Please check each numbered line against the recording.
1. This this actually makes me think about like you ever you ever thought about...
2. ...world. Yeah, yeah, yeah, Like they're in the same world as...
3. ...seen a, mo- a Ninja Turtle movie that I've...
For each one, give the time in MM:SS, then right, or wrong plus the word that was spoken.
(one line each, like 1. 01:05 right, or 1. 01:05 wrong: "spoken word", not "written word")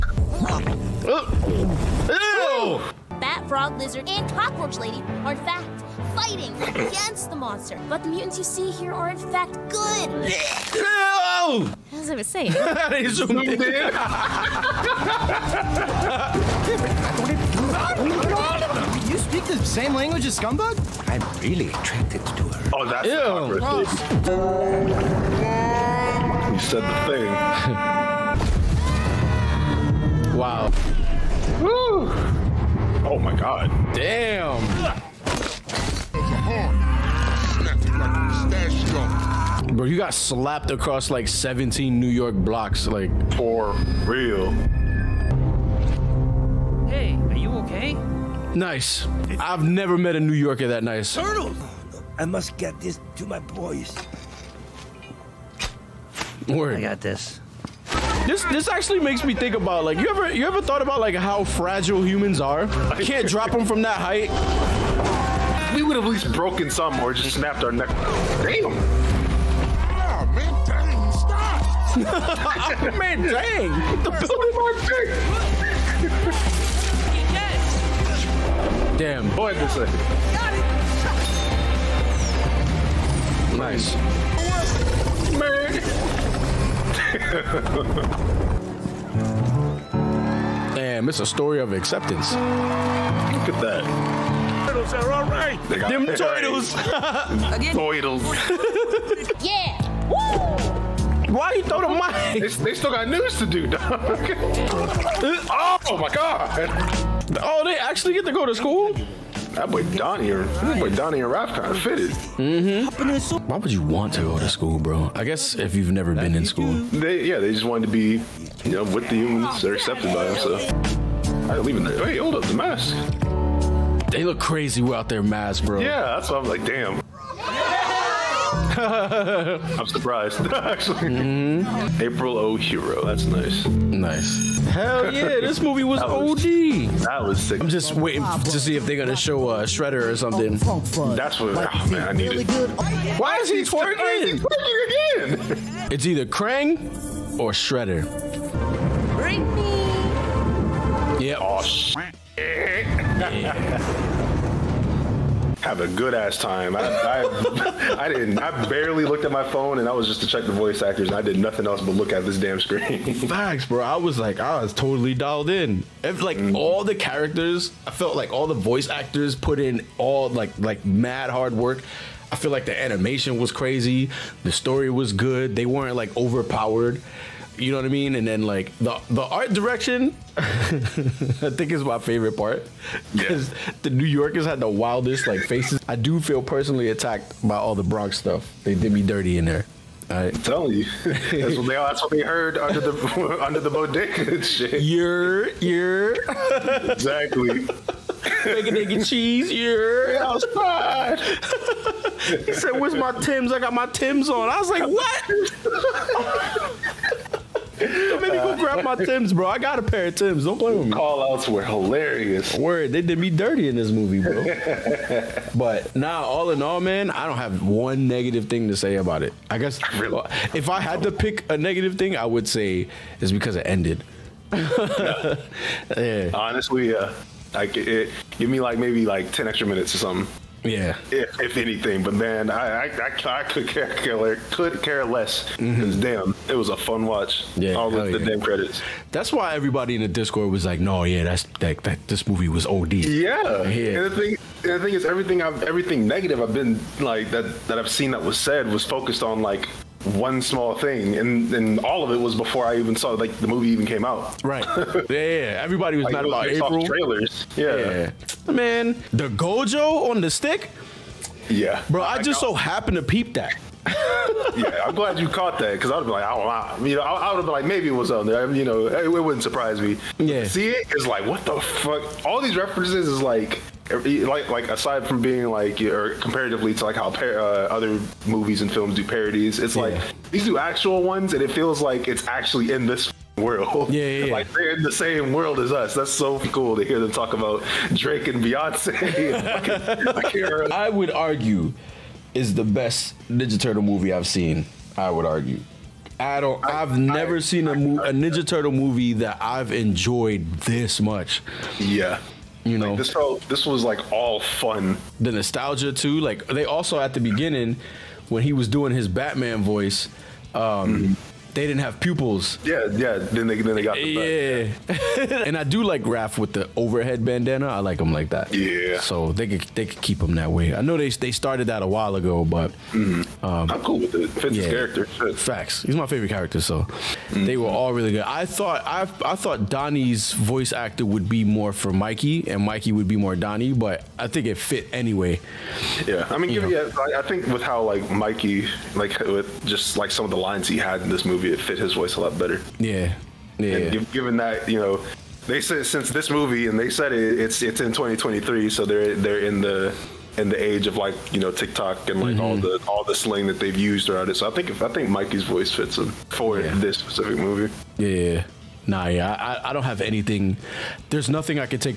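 1. 00:58 right
2. 04:43 right
3. 04:57 right.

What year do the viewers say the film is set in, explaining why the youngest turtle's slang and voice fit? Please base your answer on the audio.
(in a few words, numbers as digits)
2023.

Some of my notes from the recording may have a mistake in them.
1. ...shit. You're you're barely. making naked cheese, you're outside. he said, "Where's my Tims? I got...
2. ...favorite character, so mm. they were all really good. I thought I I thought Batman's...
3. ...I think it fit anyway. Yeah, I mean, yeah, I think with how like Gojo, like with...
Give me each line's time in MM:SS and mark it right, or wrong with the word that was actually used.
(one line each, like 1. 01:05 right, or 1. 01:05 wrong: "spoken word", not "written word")
1. 03:14 wrong: "exactly", not "barely"
2. 05:26 wrong: "Donnie", not "Batman"
3. 05:34 wrong: "Mikey", not "Gojo".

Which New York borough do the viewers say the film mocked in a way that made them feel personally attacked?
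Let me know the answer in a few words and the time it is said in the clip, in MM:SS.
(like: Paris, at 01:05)
Bronx, at 03:07.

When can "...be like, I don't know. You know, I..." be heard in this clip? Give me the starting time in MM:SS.
04:26.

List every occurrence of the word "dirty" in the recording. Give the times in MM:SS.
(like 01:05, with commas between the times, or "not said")
03:09, 03:33.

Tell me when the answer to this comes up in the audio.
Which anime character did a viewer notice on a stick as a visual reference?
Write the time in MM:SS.
04:19.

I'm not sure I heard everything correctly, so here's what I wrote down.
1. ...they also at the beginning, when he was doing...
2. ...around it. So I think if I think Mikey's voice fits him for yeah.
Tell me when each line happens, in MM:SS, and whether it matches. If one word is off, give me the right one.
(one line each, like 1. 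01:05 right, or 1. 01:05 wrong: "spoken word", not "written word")
1. 05:06 right
2. 05:54 right.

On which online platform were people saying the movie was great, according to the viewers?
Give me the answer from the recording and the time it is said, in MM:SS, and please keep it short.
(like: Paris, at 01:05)
Discord, at 04:00.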